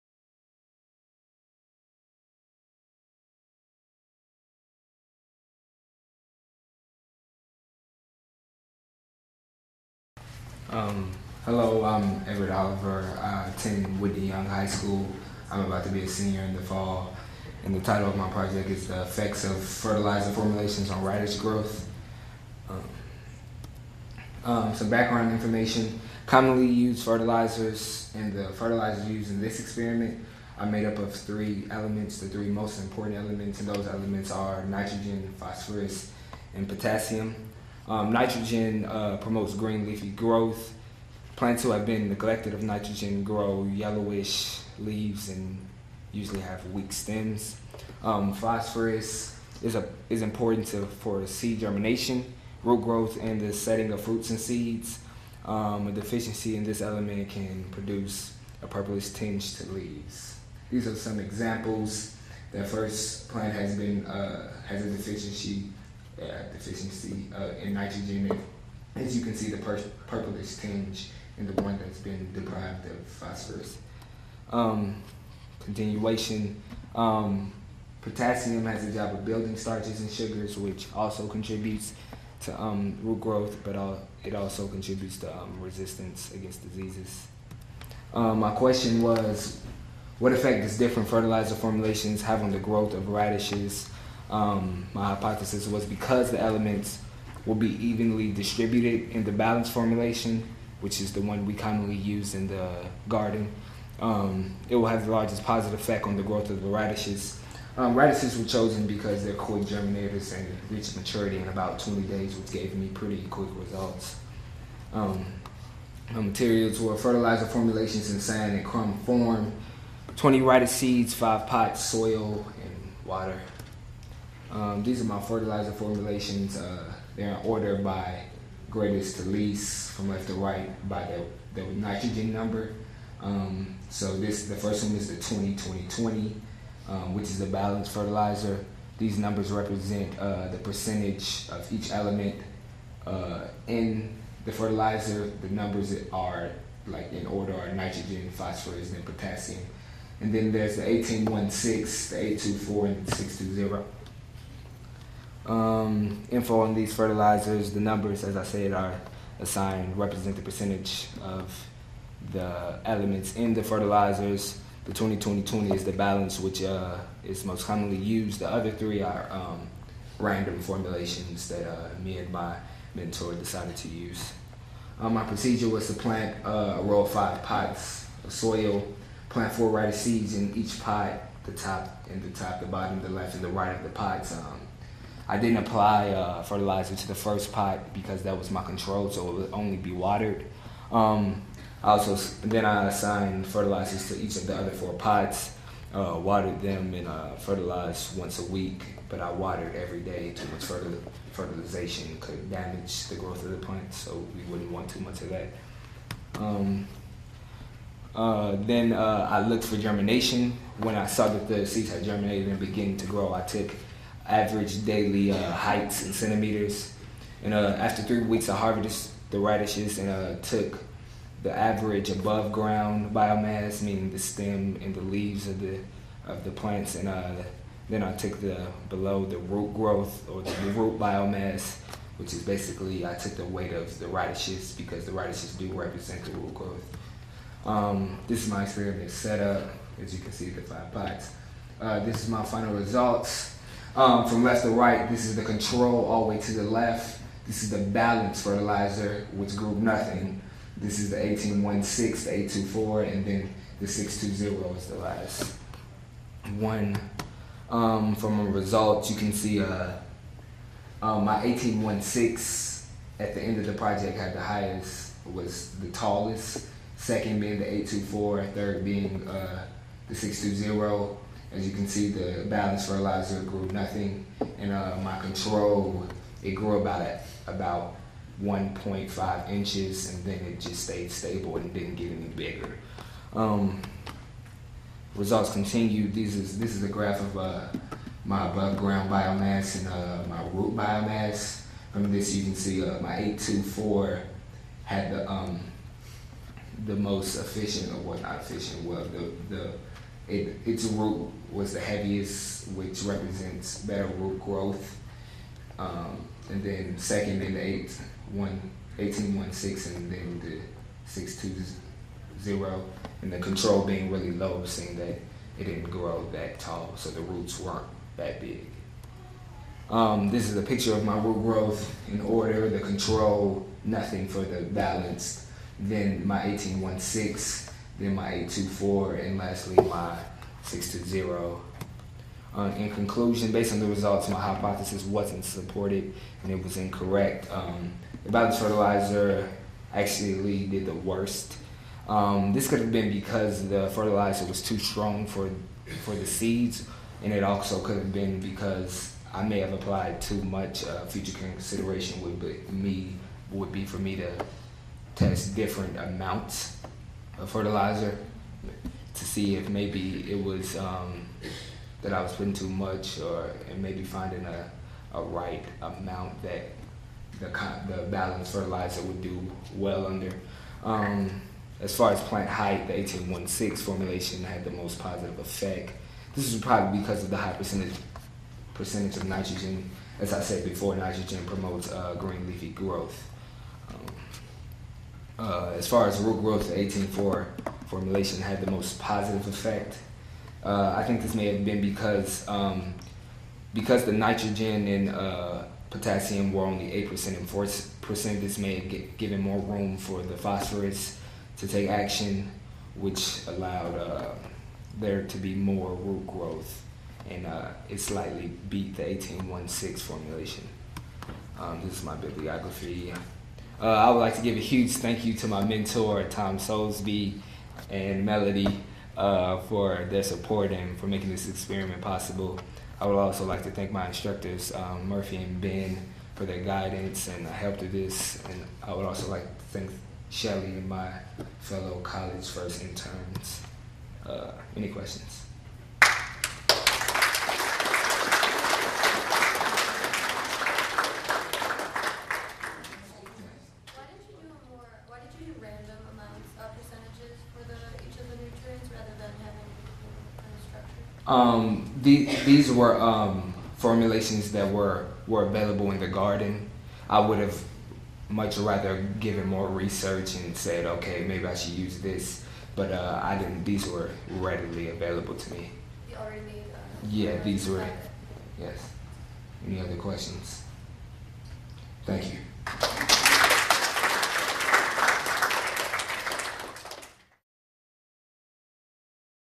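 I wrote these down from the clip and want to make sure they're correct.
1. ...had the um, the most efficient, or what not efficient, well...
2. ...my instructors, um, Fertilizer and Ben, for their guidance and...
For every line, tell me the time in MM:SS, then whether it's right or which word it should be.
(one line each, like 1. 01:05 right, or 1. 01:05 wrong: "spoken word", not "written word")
1. 04:54 right
2. 07:03 wrong: "Murphy", not "Fertilizer".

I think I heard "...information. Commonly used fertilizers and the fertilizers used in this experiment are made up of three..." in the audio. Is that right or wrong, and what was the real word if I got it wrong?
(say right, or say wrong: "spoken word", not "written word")
right.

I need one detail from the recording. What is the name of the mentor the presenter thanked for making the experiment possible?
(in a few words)
Tom Soulsby.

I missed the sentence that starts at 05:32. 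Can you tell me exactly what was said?
Uh, in conclusion, based on the results, my hypothesis wasn't supported and it was incorrect.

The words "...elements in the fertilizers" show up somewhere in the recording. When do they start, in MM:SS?
02:42.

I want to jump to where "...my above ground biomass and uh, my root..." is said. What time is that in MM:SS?
04:48.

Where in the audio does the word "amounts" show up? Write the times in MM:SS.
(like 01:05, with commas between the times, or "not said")
05:55, 06:05.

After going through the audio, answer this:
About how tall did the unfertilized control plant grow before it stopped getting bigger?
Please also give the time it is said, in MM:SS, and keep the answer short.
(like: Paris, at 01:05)
1.5 inches, at 04:38.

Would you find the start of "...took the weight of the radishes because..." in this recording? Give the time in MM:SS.
03:53.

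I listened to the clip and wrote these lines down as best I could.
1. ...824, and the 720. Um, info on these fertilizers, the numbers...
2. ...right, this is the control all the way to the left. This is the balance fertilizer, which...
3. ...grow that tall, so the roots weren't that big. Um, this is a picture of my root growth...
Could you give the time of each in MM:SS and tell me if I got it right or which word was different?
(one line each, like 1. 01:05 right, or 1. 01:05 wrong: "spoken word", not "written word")
1. 02:31 wrong: "620", not "720"
2. 04:04 right
3. 05:15 right.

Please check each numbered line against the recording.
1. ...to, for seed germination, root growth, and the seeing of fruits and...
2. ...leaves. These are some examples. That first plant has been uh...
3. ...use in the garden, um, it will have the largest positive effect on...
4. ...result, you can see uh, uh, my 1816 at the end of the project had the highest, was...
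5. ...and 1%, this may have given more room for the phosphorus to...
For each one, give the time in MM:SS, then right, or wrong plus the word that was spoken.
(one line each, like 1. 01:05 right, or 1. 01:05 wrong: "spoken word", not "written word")
1. 00:50 wrong: "setting", not "seeing"
2. 00:59 right
3. 01:41 right
4. 04:18 right
5. 06:37 wrong: "4", not "1".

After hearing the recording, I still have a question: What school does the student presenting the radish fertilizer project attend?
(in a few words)
Whitney Young High School.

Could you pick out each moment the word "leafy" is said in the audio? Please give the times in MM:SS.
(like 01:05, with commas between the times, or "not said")
00:39, 06:22.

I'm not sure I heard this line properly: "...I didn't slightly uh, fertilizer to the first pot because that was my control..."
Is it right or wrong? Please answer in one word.
wrong.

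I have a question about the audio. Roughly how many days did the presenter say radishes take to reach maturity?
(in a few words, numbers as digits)
20 days.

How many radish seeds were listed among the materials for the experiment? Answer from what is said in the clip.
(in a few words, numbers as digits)
20.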